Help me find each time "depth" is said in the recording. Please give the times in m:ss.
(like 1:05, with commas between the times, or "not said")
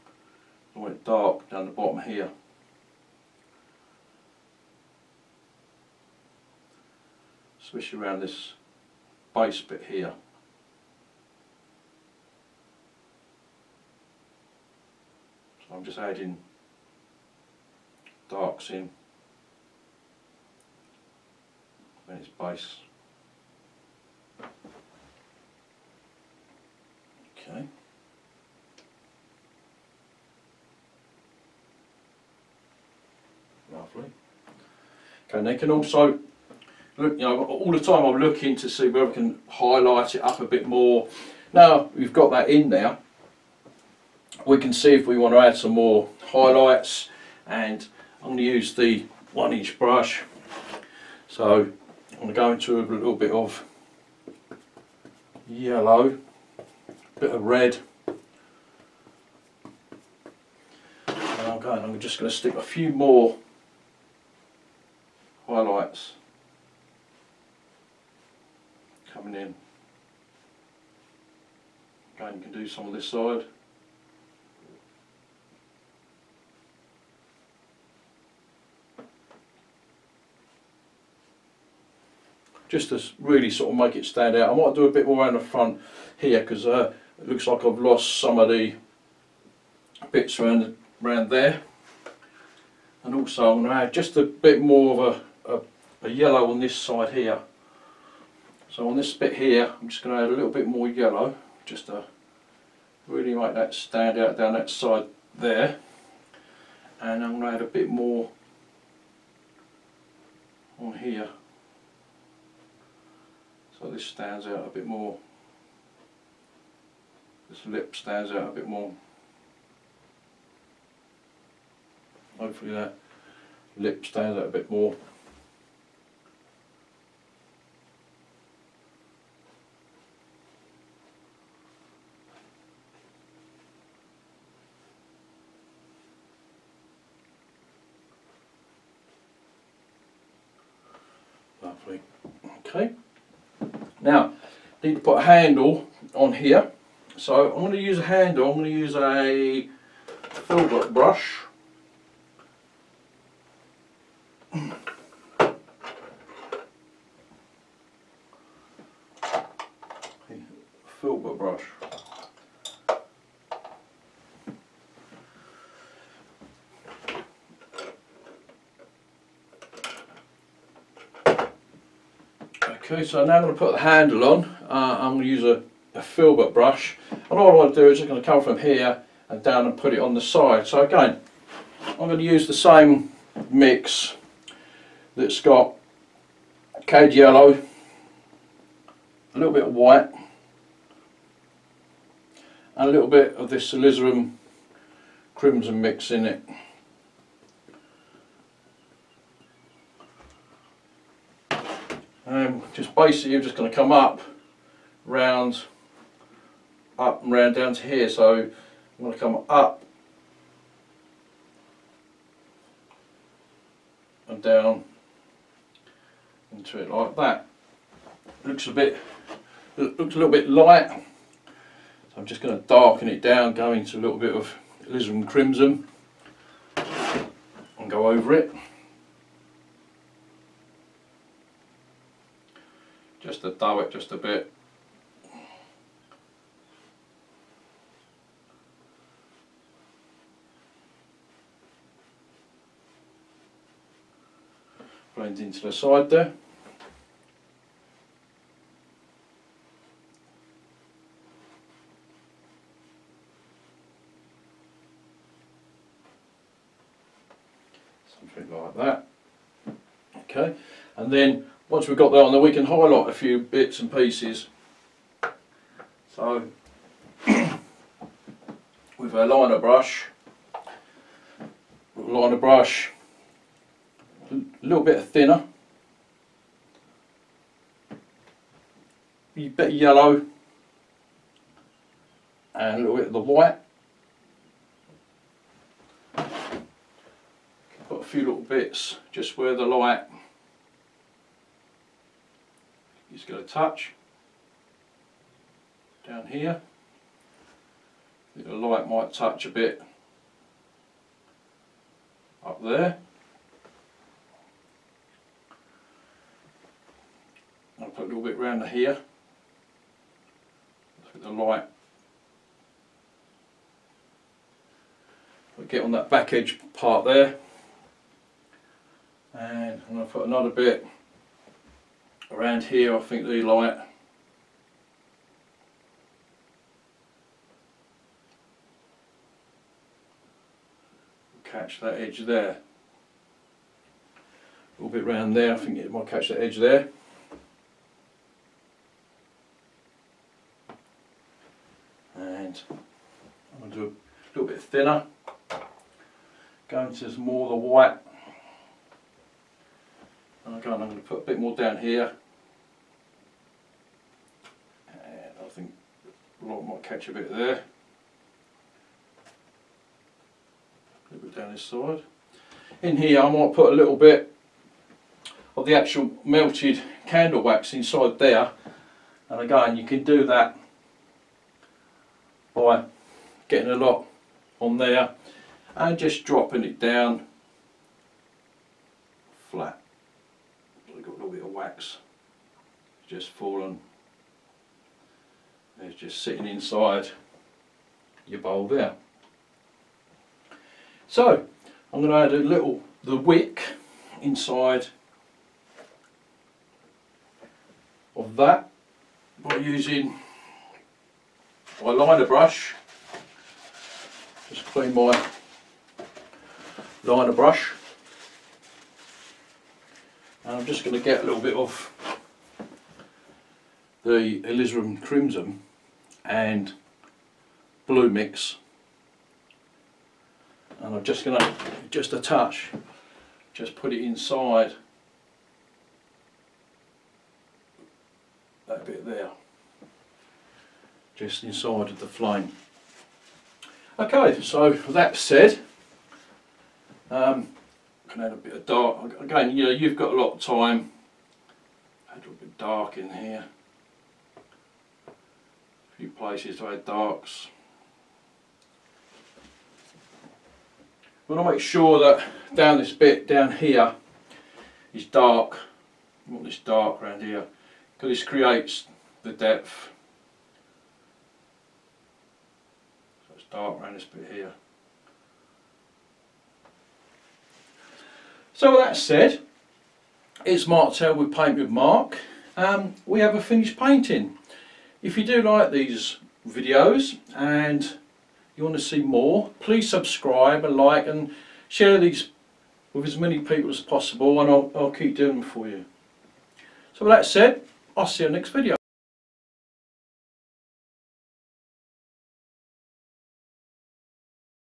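7:39.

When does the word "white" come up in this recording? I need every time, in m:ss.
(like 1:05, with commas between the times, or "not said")
3:09, 4:43, 5:47.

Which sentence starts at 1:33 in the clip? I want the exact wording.
And also I'm going to add just a bit more of a, a, a yellow on this side here.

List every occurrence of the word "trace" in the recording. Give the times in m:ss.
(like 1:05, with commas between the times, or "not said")
not said.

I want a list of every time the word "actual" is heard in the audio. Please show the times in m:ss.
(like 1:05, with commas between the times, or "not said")
6:05.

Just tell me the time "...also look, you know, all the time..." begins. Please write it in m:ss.
0:35.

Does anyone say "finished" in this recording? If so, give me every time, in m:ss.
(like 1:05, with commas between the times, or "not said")
7:53.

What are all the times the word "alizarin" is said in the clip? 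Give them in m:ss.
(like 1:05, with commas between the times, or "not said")
3:13, 3:44, 6:54.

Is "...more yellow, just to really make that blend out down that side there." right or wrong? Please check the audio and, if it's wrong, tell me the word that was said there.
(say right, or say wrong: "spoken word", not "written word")
wrong: "stand", not "blend".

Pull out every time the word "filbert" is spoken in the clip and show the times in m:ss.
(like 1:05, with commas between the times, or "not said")
2:30, 2:56.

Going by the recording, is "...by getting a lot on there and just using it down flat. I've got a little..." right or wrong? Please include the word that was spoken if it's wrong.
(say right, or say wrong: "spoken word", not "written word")
wrong: "dropping", not "using".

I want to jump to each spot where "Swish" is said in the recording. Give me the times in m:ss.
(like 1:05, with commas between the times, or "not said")
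0:07.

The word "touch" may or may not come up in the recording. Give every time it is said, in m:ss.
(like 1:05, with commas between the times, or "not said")
4:53, 4:59, 7:02.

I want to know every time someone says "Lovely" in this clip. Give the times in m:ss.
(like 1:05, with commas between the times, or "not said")
0:33, 2:21.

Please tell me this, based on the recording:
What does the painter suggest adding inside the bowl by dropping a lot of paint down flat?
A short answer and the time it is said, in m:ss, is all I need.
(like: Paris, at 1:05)
Melted candle wax, at 6:06.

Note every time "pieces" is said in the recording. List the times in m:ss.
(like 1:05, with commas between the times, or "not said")
4:23.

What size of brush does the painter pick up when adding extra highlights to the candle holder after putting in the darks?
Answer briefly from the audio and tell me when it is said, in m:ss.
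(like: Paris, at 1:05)
1 inch, at 0:49.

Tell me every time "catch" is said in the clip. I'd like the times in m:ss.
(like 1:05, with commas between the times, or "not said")
5:31, 5:36, 5:56.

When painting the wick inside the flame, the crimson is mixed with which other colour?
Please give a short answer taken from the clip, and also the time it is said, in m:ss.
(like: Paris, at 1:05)
Blue, at 6:57.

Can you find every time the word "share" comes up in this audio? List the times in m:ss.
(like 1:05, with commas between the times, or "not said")
8:01.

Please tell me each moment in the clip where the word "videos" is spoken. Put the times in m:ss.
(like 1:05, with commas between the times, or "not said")
7:56, 8:08.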